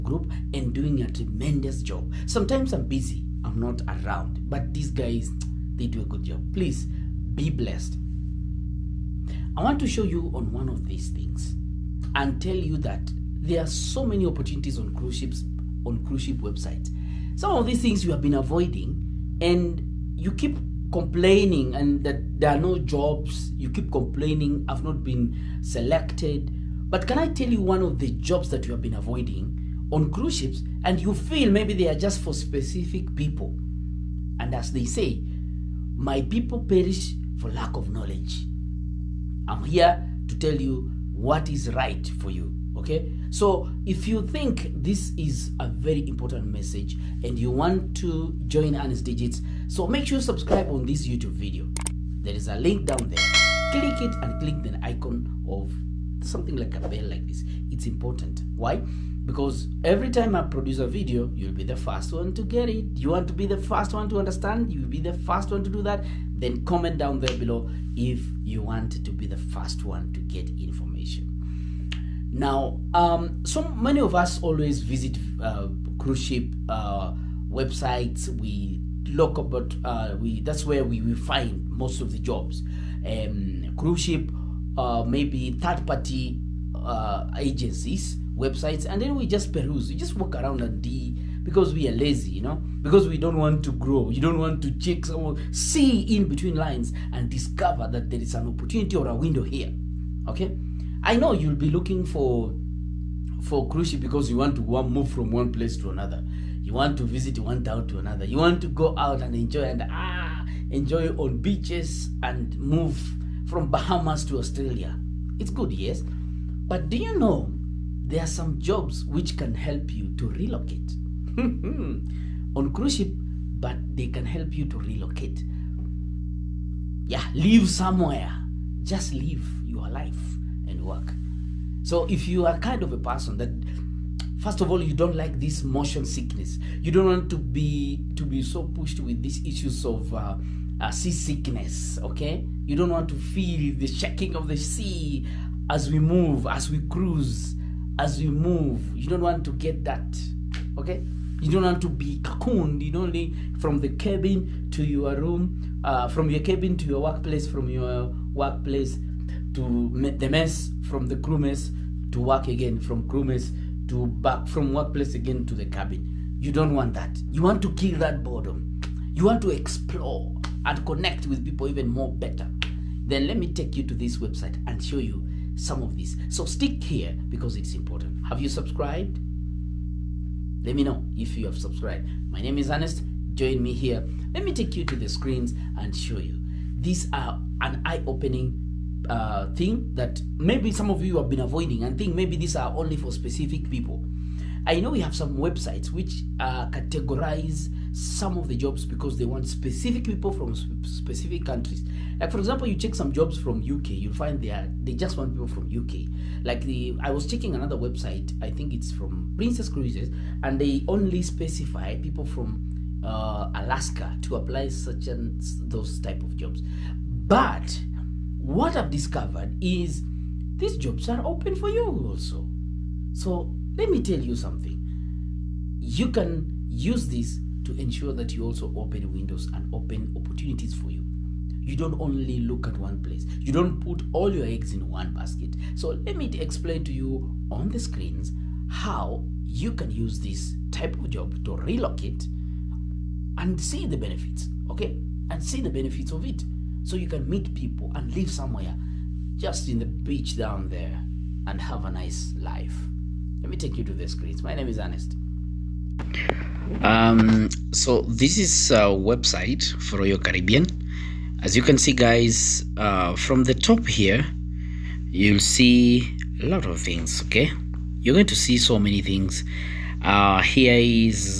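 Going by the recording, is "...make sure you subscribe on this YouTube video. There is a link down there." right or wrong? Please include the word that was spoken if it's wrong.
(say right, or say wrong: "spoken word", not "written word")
right.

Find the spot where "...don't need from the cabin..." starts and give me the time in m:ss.
2:32.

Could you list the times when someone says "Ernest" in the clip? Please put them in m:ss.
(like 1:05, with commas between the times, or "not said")
3:02, 4:14.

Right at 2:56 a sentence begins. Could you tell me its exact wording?
So stick here because it's important.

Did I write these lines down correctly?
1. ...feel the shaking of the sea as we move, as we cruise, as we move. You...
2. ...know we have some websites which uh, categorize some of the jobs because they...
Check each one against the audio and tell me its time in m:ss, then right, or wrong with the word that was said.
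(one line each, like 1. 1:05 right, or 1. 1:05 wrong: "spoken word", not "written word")
1. 2:23 right
2. 3:14 right.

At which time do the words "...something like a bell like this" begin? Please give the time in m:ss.
0:56.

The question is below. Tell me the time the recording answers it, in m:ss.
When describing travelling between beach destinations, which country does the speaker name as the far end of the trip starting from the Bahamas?
1:54.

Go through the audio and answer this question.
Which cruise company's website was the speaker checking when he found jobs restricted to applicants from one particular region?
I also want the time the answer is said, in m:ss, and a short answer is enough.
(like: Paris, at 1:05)
Princess Cruises, at 3:29.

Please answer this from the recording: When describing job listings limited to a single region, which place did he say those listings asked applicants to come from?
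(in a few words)
Alaska.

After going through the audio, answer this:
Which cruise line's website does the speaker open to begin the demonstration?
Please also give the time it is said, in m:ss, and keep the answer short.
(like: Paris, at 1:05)
Royal Caribbean, at 4:19.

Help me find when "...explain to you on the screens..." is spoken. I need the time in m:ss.
3:56.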